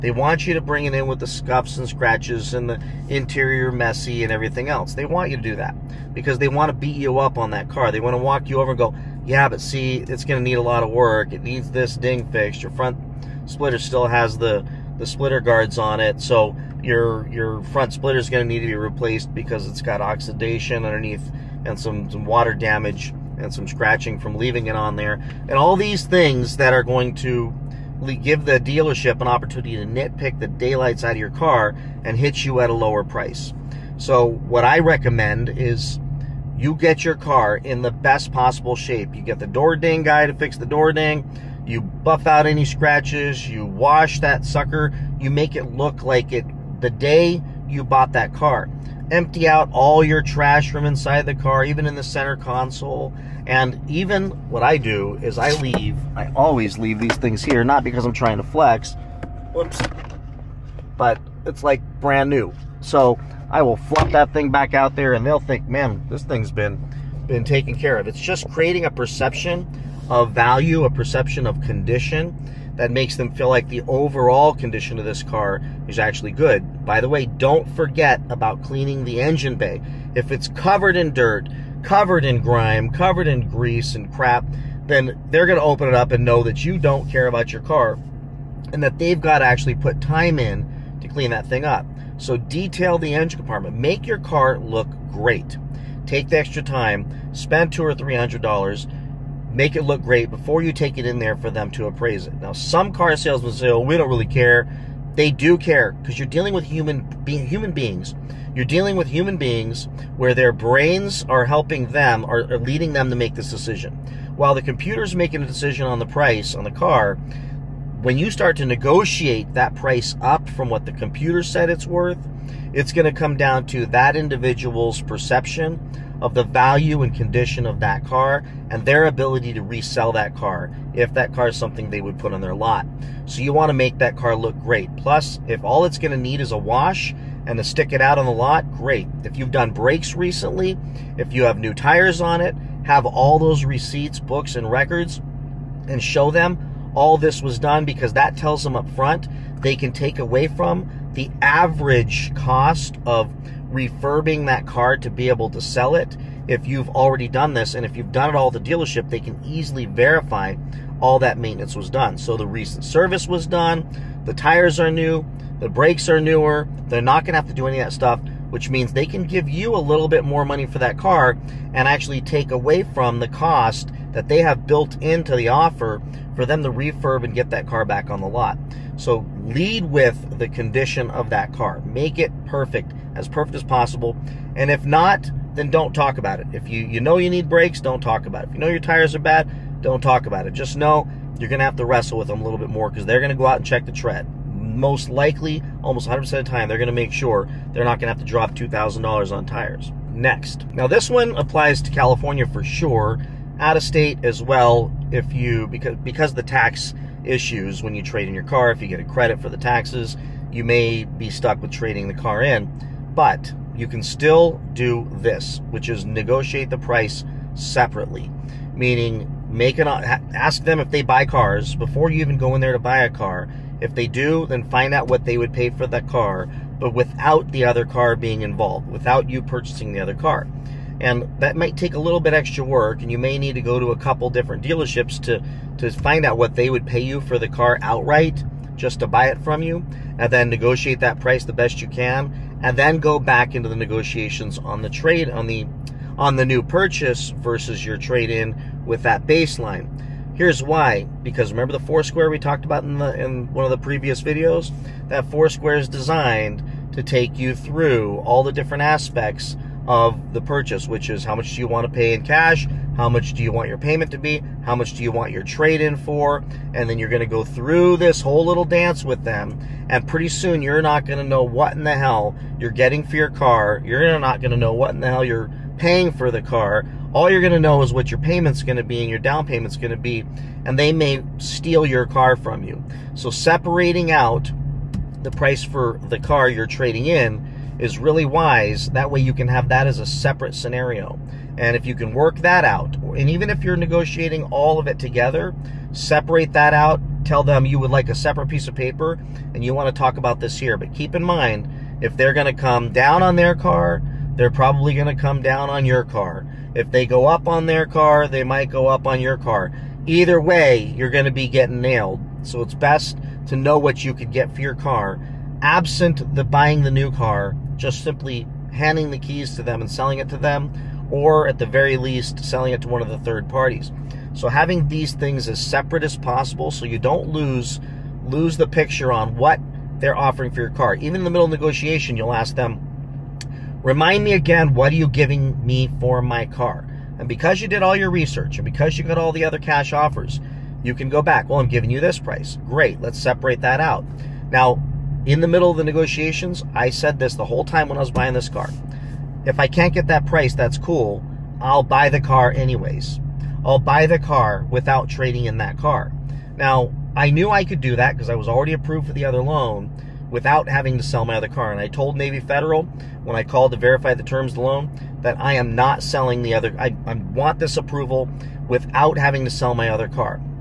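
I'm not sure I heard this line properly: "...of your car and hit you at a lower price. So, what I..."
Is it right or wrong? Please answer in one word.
right.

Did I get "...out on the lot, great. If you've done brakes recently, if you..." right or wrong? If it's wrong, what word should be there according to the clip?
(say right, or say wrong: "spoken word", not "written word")
right.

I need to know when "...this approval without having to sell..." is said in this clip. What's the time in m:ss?
6:07.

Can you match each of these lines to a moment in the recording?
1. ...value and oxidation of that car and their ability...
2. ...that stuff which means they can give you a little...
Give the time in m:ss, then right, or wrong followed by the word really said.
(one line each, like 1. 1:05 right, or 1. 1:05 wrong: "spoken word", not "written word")
1. 2:06 wrong: "condition", not "oxidation"
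2. 2:47 right.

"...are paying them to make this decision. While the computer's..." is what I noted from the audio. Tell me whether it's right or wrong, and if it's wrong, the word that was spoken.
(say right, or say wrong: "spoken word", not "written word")
wrong: "leading", not "paying".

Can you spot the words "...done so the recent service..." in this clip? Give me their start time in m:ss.
2:41.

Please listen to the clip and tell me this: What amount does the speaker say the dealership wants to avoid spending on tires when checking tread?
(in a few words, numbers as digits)
$2,000.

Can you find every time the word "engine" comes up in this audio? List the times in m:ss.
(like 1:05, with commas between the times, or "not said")
1:19, 1:33.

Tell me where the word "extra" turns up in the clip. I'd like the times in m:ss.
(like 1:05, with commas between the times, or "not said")
1:36, 3:52.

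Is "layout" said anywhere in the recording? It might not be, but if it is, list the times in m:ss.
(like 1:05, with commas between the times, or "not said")
not said.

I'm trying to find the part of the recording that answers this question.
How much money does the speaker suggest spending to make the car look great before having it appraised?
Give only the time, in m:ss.
1:37.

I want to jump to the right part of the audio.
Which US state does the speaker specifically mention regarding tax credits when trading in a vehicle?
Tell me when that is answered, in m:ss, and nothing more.
3:21.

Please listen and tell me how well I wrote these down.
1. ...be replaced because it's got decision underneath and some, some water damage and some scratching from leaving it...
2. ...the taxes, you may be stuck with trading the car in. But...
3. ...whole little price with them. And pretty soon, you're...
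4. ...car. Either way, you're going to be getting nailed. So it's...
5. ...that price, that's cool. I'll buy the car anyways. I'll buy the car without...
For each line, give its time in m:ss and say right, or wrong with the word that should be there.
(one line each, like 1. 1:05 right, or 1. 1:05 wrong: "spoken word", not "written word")
1. 0:18 wrong: "oxidation", not "decision"
2. 3:29 right
3. 4:28 wrong: "dance", not "price"
4. 5:09 right
5. 5:50 right.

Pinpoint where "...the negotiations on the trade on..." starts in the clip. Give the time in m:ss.
4:03.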